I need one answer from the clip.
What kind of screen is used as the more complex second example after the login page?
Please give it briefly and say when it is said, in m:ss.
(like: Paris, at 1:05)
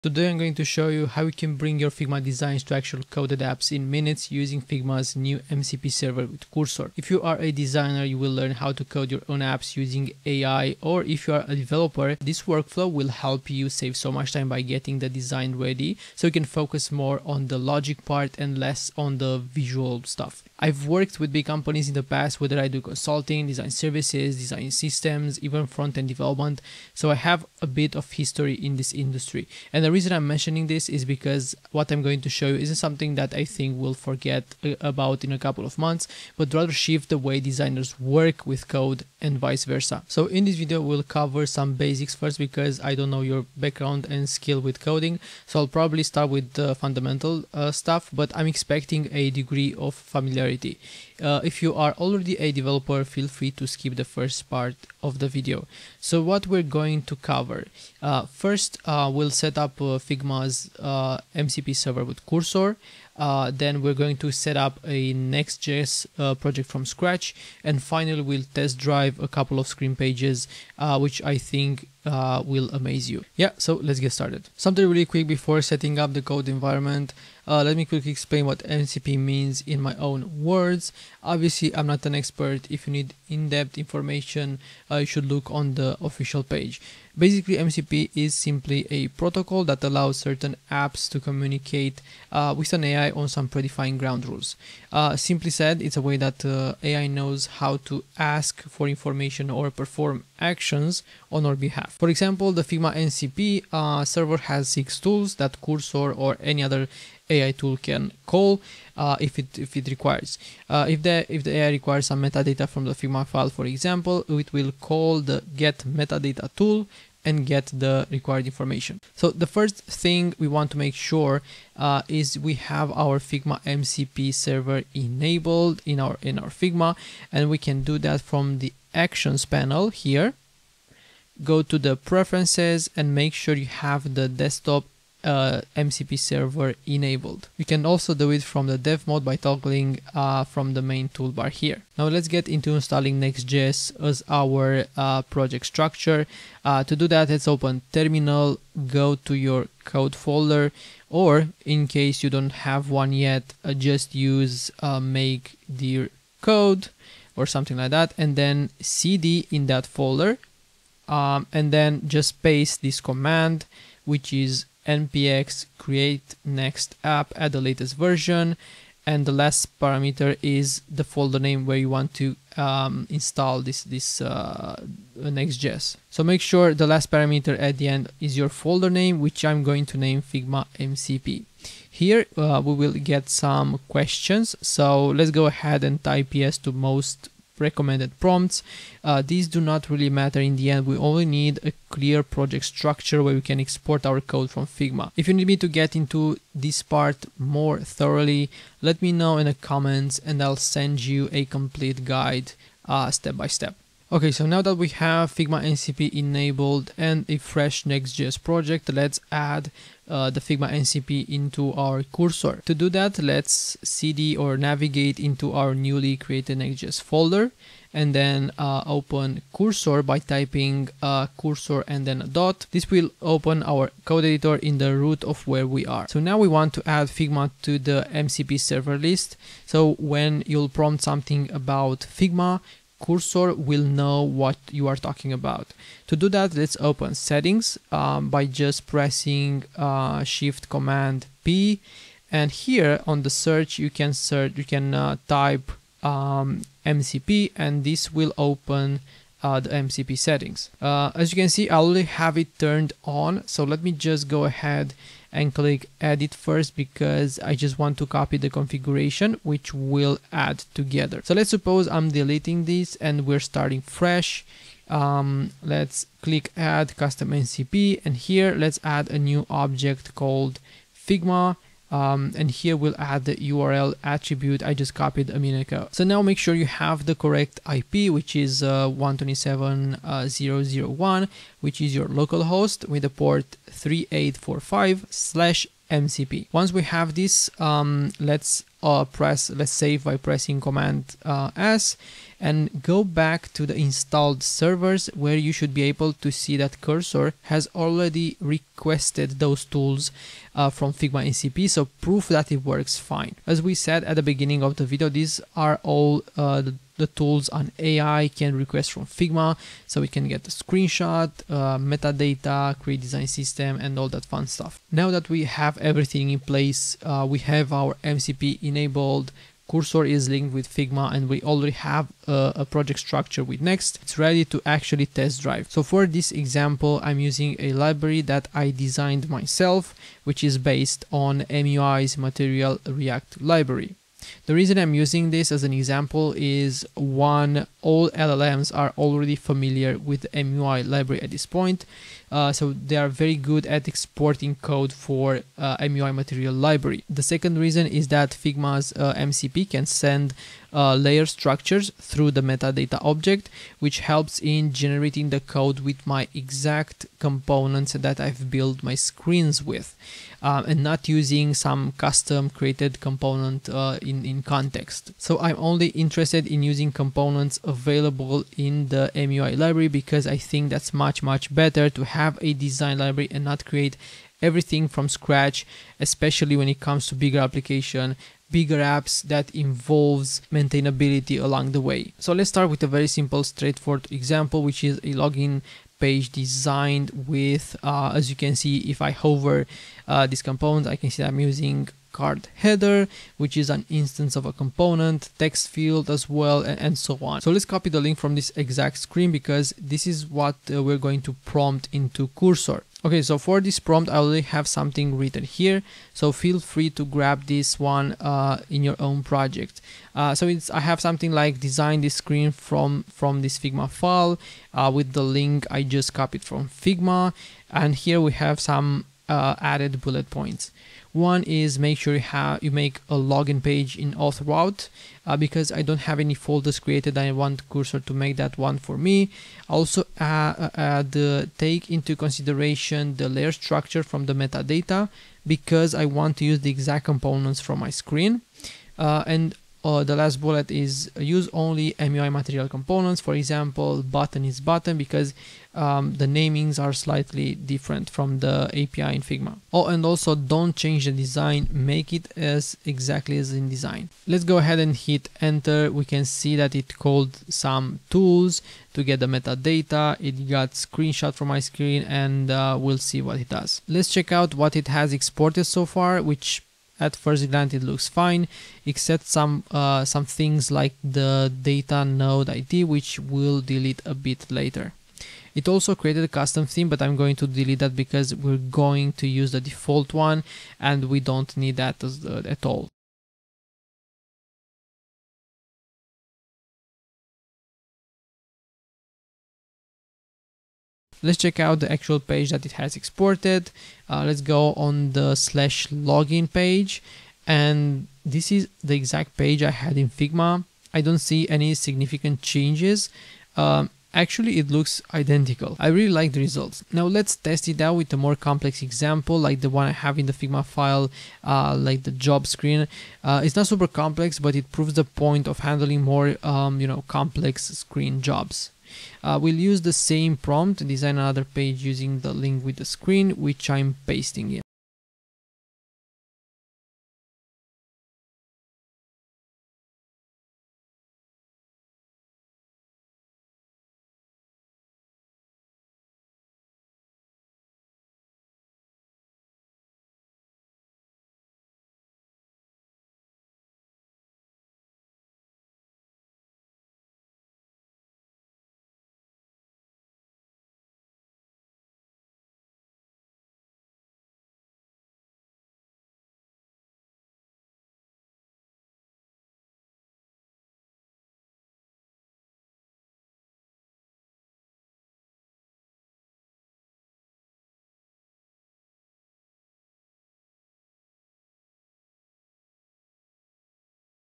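job screen, at 8:32.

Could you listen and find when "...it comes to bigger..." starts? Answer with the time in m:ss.
6:16.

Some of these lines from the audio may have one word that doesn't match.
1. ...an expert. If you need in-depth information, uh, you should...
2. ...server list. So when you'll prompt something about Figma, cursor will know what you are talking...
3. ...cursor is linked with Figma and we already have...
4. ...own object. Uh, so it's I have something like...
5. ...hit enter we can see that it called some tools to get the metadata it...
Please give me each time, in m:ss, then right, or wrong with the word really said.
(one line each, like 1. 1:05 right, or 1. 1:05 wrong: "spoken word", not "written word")
1. 1:22 right
2. 3:48 right
3. 5:19 right
4. 6:48 wrong: "project", not "object"
5. 7:34 right.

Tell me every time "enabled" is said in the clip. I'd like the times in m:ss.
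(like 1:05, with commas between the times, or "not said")
2:04, 2:16, 3:26, 5:18.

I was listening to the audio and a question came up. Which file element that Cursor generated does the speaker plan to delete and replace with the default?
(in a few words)
custom theme.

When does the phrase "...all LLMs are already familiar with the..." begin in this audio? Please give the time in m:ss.
5:37.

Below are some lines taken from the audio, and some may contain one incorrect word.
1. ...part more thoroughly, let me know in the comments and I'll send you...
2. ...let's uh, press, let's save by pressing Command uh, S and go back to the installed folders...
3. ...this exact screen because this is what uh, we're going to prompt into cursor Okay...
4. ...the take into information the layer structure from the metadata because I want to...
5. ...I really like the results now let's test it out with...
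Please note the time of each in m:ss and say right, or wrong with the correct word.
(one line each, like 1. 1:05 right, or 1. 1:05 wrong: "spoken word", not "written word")
1. 3:16 right
2. 4:48 wrong: "servers", not "folders"
3. 6:38 right
4. 7:11 wrong: "consideration", not "information"
5. 8:25 right.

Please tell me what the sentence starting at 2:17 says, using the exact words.
You can also do it from the dev mode by toggling uh, from the main toolbar here.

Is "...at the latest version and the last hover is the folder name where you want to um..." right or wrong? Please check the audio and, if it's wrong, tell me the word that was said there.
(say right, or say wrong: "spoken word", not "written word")
wrong: "parameter", not "hover".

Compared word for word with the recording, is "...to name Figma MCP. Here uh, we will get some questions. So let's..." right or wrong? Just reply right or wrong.
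right.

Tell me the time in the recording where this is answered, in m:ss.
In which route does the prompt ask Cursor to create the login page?
7:04.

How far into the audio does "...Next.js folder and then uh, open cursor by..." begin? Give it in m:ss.
3:36.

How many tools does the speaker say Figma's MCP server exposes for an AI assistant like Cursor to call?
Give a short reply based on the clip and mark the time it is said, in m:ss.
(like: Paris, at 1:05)
6, at 1:44.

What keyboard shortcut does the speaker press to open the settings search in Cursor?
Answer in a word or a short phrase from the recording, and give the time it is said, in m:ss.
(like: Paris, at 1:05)
Shift Command P, at 4:00.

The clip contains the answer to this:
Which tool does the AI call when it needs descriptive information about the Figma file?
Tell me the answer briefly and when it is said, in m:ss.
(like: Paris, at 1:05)
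get metadata, at 1:55.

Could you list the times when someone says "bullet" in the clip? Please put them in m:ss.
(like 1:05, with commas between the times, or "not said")
7:00, 7:20.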